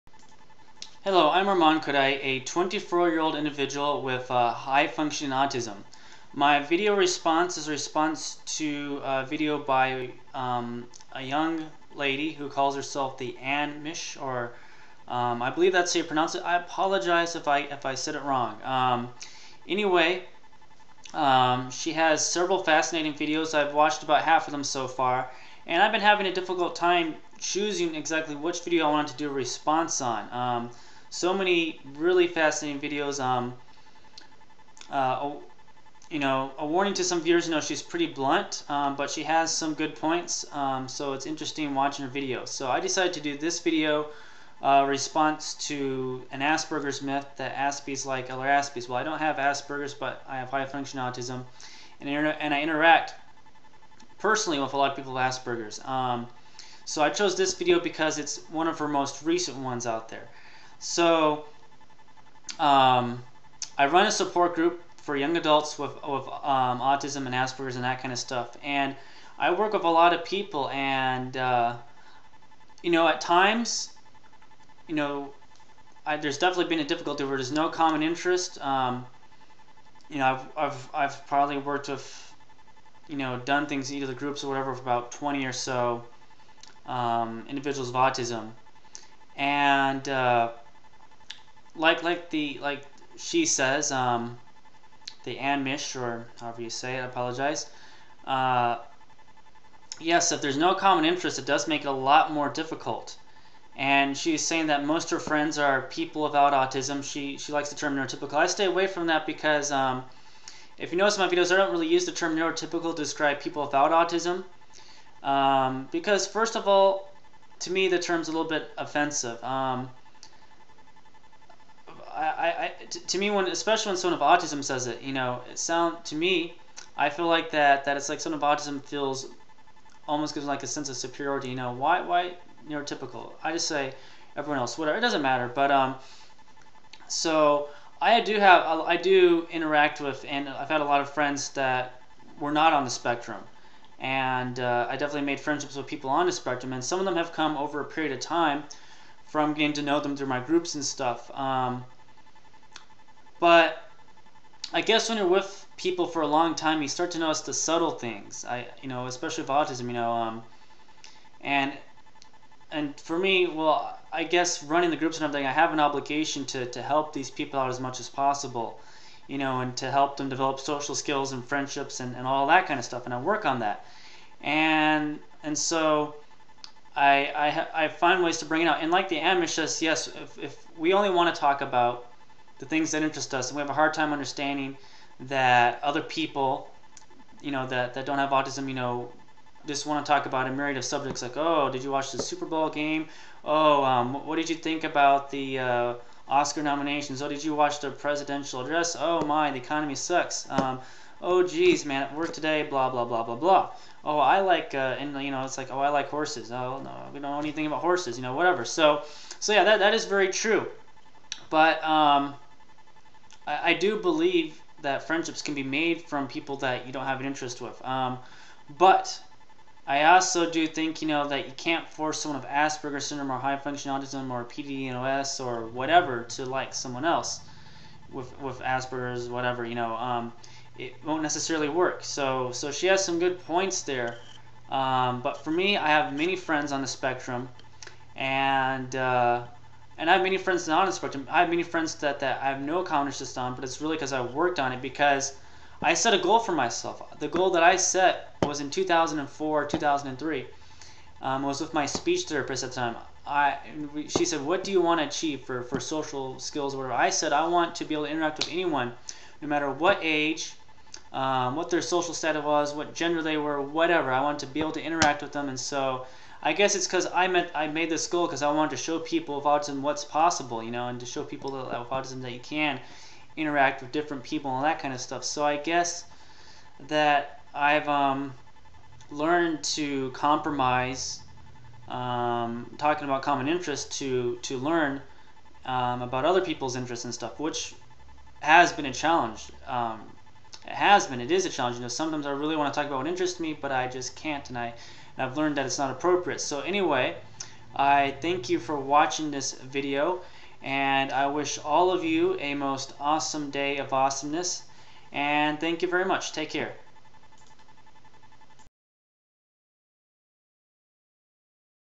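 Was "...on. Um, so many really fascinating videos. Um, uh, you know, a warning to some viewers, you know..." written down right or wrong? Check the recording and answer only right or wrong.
right.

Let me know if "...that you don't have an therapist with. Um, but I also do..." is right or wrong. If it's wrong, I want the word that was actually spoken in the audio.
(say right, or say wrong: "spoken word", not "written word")
wrong: "interest", not "therapist".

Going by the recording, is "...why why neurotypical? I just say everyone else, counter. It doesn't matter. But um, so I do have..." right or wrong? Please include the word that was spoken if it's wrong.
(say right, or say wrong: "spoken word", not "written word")
wrong: "whatever", not "counter".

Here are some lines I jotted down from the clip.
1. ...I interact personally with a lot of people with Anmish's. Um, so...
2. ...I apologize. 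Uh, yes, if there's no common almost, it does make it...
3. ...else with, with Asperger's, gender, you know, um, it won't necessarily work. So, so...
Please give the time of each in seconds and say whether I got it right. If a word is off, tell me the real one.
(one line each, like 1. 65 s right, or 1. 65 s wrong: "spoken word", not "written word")
1. 52 s wrong: "Asperger", not "Anmish"
2. 97 s wrong: "interest", not "almost"
3. 227 s wrong: "whatever", not "gender".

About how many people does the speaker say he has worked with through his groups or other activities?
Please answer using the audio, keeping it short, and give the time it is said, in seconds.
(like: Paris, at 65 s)
20, at 85 s.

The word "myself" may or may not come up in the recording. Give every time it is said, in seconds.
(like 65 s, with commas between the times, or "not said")
246 s.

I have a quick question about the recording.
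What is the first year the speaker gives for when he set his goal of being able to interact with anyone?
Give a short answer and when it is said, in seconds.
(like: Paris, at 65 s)
2004, at 248 s.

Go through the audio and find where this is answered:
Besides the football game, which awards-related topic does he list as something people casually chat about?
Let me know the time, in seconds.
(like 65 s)
196 s.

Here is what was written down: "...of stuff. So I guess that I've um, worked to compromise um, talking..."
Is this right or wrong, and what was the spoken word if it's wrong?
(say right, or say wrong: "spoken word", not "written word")
wrong: "learned", not "worked".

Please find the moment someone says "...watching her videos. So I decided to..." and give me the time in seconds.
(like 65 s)
41 s.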